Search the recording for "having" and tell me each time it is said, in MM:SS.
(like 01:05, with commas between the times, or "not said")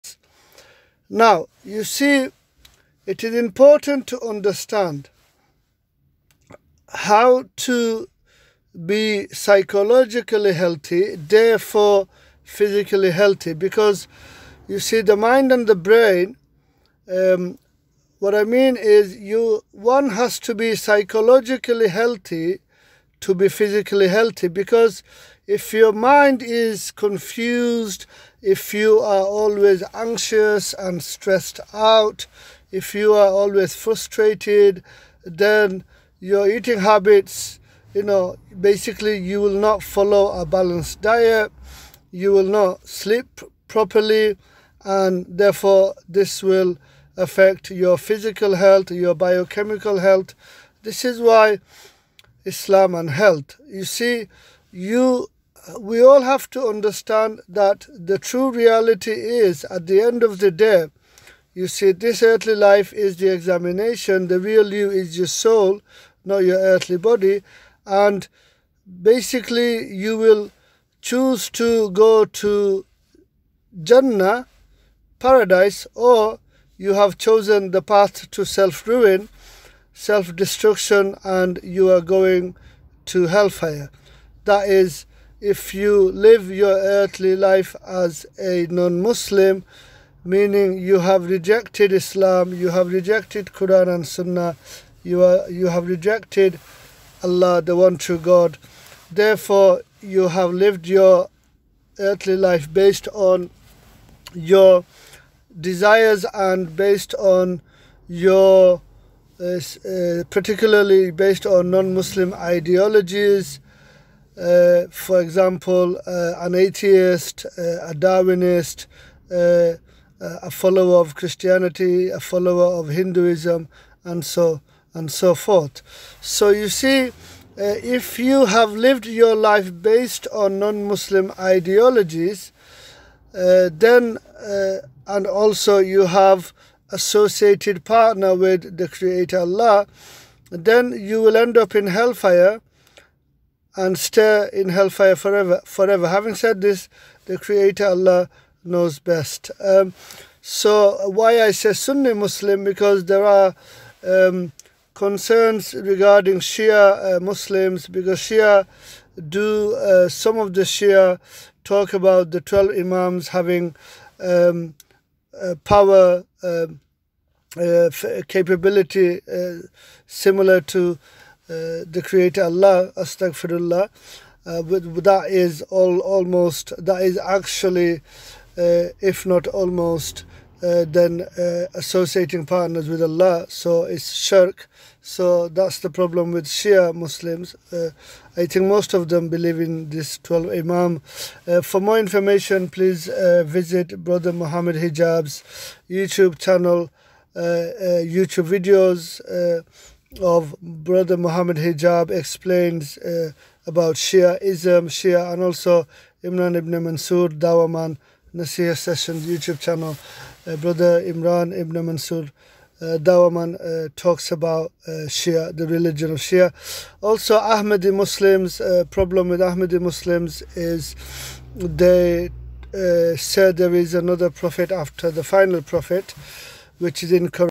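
02:26, 02:43.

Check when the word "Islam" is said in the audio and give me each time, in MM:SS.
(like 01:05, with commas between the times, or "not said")
00:52, 01:31.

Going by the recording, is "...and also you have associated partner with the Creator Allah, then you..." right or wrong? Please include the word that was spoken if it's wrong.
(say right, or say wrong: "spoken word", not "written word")
right.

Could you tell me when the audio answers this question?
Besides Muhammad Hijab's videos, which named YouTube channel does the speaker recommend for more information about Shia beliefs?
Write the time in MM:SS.
03:28.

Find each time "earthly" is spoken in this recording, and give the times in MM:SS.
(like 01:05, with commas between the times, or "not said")
01:02, 01:06, 01:26, 01:41.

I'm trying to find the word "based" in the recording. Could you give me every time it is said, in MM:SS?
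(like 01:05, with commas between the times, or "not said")
01:42, 01:46, 01:51, 02:09.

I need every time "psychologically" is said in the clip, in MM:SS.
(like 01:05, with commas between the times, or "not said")
00:09, 00:20.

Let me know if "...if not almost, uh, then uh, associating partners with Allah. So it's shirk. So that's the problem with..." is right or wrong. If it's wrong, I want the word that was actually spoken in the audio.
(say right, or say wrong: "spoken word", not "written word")
right.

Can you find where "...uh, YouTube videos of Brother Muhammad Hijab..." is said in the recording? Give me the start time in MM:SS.
03:17.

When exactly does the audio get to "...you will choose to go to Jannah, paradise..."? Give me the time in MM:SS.
01:09.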